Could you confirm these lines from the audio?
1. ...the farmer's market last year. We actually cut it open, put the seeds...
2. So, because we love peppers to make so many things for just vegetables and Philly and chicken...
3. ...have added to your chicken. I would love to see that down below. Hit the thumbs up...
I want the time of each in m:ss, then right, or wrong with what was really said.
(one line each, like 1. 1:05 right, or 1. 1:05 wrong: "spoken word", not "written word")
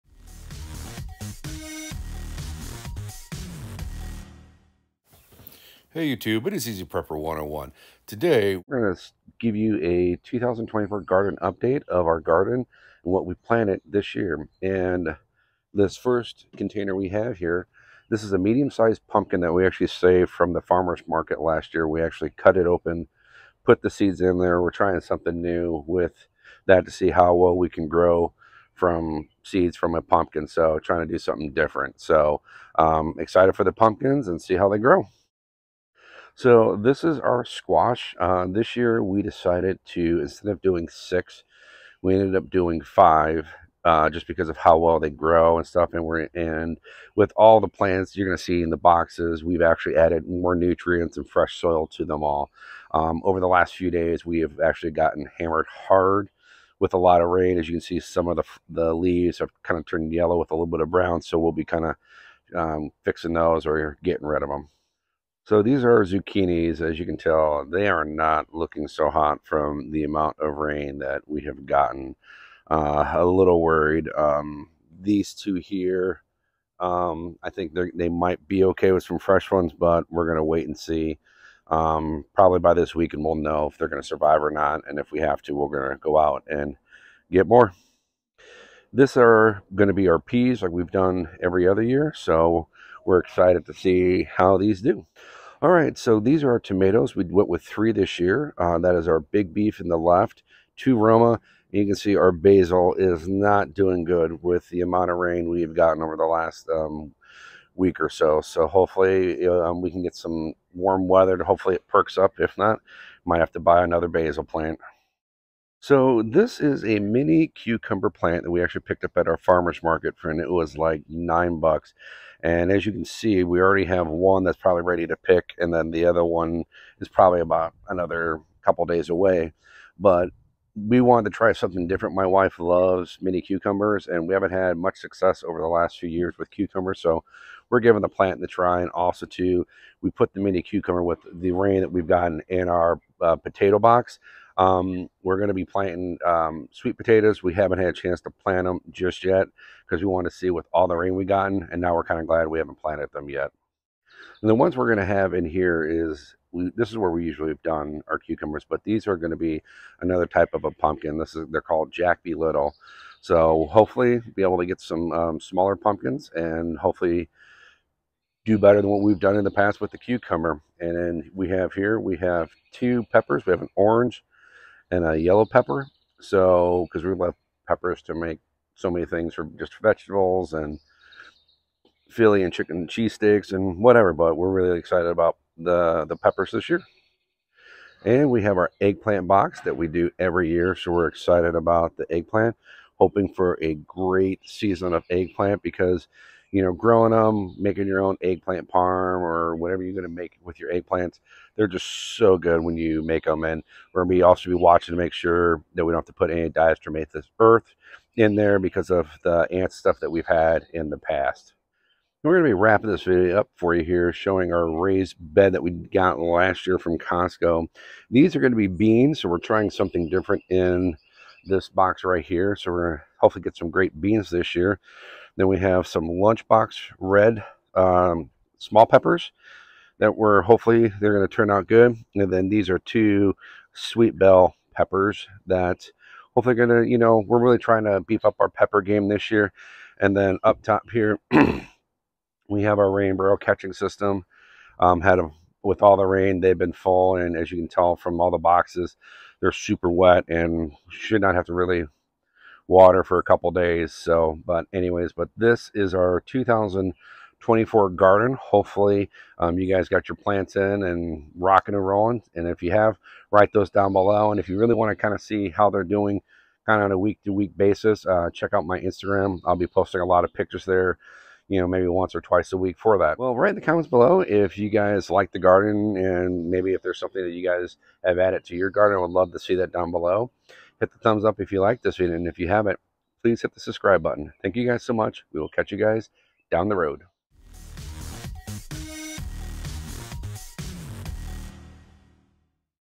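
1. 0:20 right
2. 2:56 right
3. 4:38 wrong: "garden", not "chicken".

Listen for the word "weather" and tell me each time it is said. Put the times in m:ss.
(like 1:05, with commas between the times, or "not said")
1:51.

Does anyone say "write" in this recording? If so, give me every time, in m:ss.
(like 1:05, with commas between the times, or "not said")
4:23, 4:33.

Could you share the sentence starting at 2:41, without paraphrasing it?
This is they're called Jack Be Little.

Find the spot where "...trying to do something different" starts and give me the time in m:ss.
0:30.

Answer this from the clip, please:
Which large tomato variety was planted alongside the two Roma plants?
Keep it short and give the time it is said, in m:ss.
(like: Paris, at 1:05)
Big Beef, at 1:39.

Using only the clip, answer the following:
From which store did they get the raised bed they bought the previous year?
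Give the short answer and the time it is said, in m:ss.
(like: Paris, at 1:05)
Costco, at 3:36.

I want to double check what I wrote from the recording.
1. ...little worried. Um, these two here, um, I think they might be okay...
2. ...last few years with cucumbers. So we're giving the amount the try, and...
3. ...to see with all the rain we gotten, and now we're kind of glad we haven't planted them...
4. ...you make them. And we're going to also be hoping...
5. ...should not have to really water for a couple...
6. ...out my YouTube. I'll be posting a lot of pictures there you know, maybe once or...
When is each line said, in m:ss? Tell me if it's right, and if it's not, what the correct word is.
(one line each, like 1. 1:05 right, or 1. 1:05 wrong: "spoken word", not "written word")
1. 1:13 right
2. 2:15 wrong: "plant", not "amount"
3. 2:30 right
4. 3:22 wrong: "watching", not "hoping"
5. 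4:10 right
6. 4:28 wrong: "Instagram", not "YouTube".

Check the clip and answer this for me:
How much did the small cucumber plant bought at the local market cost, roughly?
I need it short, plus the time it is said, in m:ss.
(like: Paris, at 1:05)
$9, at 2:01.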